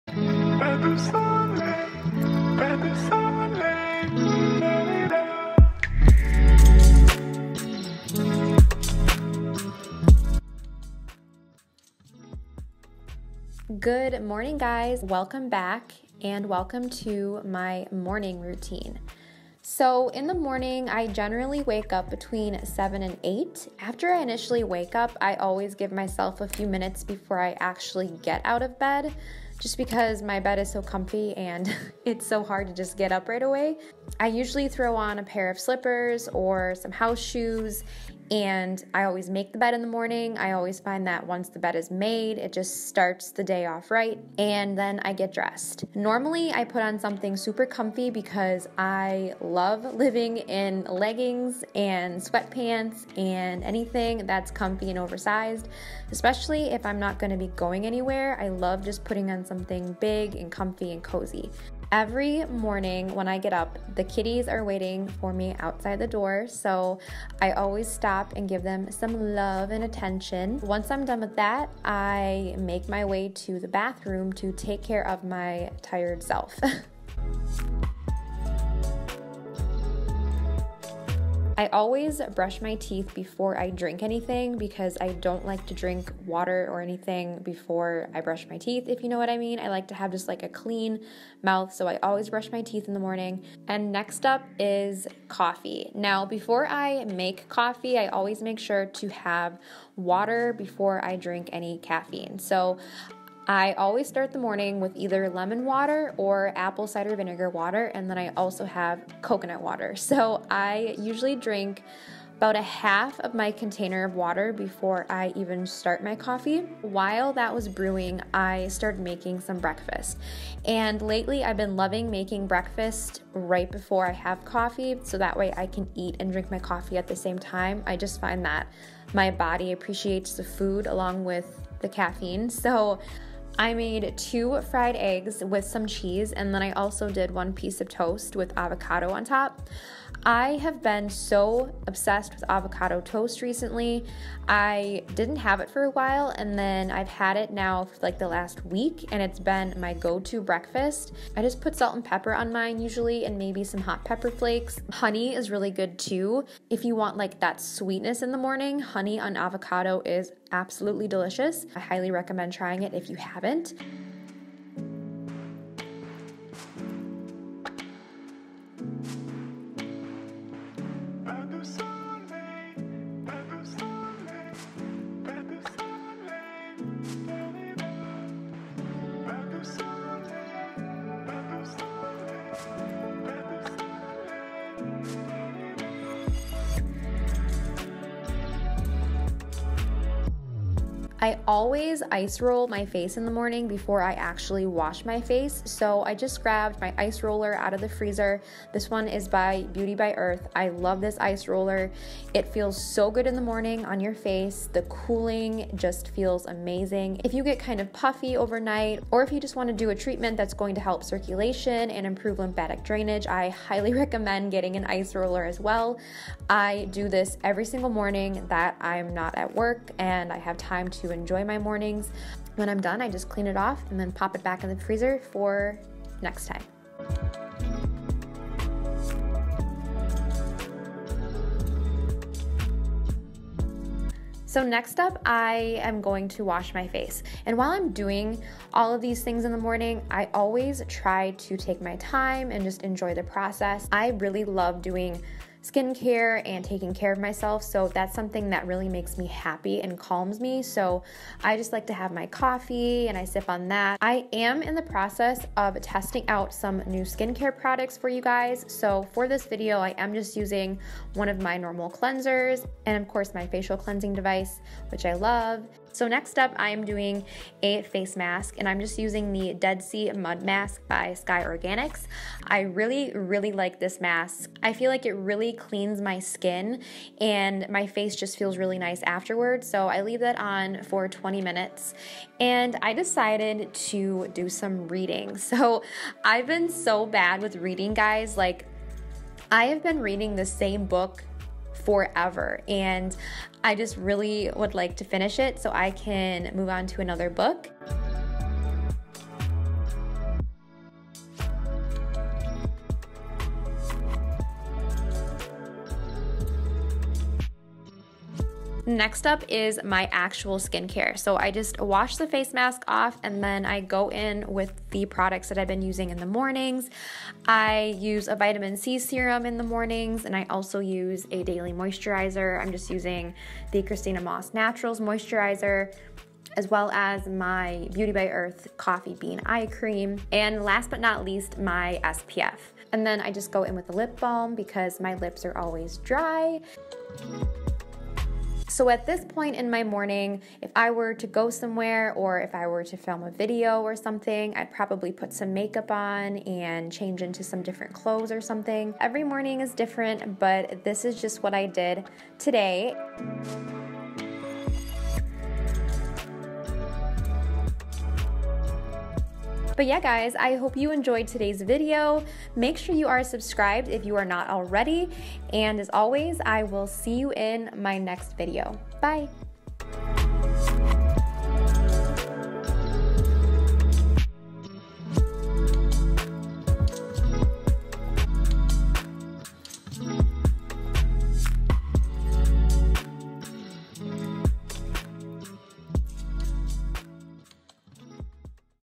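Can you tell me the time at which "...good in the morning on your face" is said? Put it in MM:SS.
03:23.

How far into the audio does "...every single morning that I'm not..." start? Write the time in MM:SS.
03:37.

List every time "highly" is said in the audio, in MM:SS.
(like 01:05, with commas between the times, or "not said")
02:41, 03:33.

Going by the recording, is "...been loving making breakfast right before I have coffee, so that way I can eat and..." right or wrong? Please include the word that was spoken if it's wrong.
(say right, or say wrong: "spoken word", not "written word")
right.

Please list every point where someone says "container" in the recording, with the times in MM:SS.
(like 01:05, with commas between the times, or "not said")
01:53.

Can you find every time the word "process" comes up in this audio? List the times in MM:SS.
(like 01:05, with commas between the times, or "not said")
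04:03, 04:14.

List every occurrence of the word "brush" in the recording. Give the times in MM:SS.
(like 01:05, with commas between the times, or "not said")
01:22, 01:28, 01:32.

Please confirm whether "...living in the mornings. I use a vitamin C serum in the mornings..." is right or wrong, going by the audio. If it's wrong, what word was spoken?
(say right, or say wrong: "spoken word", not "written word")
wrong: "using", not "living".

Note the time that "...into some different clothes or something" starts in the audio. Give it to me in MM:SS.
05:47.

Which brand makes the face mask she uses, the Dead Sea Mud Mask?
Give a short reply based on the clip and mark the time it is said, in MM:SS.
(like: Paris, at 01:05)
Sky Organics, at 04:31.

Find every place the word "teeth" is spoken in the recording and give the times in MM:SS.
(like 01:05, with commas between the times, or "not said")
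01:22, 01:28, 01:32.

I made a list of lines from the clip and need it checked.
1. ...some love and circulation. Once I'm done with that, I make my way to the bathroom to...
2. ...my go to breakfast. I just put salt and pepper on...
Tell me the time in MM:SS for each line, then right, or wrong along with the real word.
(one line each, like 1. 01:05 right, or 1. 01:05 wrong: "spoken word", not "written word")
1. 01:08 wrong: "attention", not "circulation"
2. 02:29 right.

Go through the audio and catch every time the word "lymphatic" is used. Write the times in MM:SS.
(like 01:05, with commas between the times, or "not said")
03:32.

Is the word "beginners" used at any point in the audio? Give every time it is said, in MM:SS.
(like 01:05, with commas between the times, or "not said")
not said.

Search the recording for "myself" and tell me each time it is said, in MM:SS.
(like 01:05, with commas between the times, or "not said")
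00:25, 04:07.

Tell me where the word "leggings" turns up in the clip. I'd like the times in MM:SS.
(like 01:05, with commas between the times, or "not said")
00:50.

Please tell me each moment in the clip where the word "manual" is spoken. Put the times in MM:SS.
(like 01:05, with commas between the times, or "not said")
not said.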